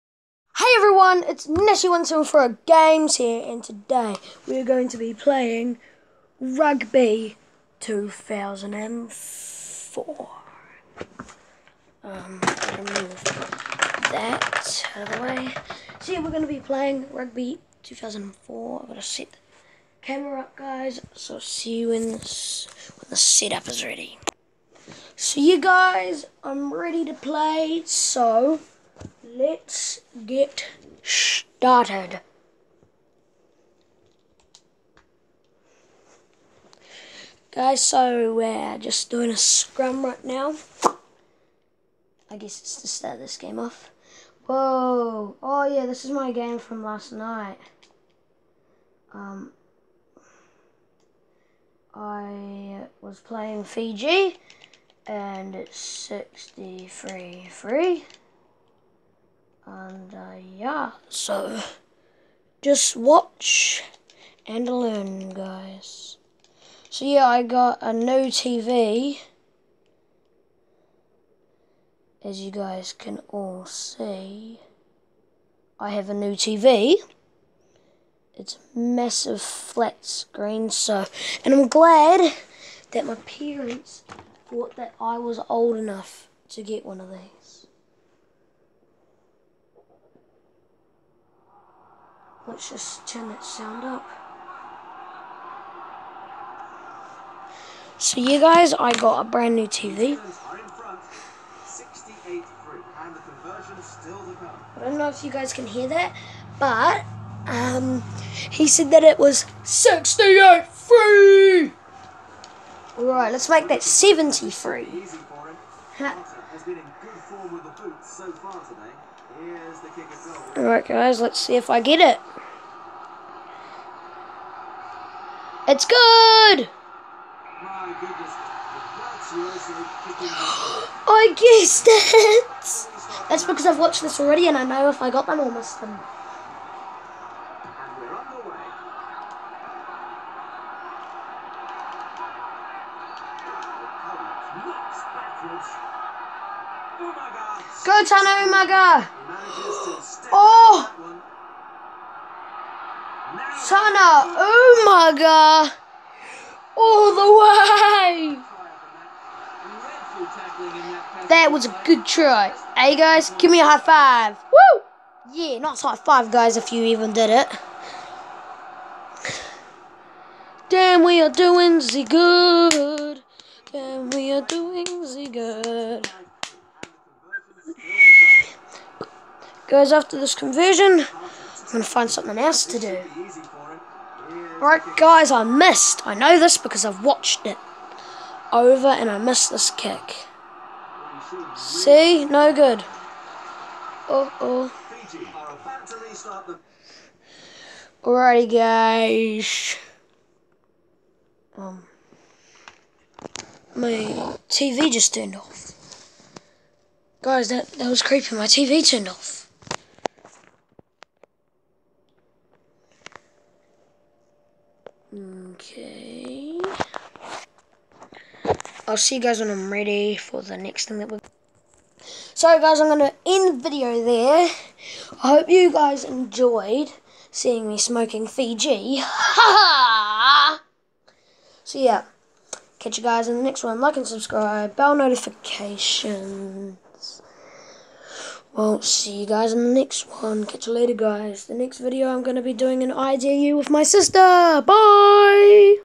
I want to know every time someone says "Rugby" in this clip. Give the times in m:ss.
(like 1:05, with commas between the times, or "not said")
0:06, 0:17.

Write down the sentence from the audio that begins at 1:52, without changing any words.
All right, let's make that 70 free.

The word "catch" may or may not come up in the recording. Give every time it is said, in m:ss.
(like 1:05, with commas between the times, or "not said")
3:52, 4:00.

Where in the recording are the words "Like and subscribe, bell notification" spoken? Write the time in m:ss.
3:53.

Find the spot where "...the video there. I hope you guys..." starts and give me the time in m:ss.
3:43.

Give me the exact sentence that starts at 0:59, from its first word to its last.
And uh, yeah, so just watch and learn, guys.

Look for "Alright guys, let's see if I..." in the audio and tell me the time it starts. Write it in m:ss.
2:00.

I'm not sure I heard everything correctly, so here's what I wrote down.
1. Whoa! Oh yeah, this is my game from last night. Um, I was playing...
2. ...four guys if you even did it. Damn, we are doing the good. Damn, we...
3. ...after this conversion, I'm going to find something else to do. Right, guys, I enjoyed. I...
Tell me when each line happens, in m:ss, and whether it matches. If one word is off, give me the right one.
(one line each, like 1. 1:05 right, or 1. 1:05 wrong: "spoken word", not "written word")
1. 0:44 right
2. 2:45 wrong: "five", not "four"
3. 2:59 wrong: "missed", not "enjoyed".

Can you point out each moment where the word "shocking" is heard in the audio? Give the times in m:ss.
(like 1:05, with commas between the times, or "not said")
not said.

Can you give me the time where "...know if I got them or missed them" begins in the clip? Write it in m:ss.
2:14.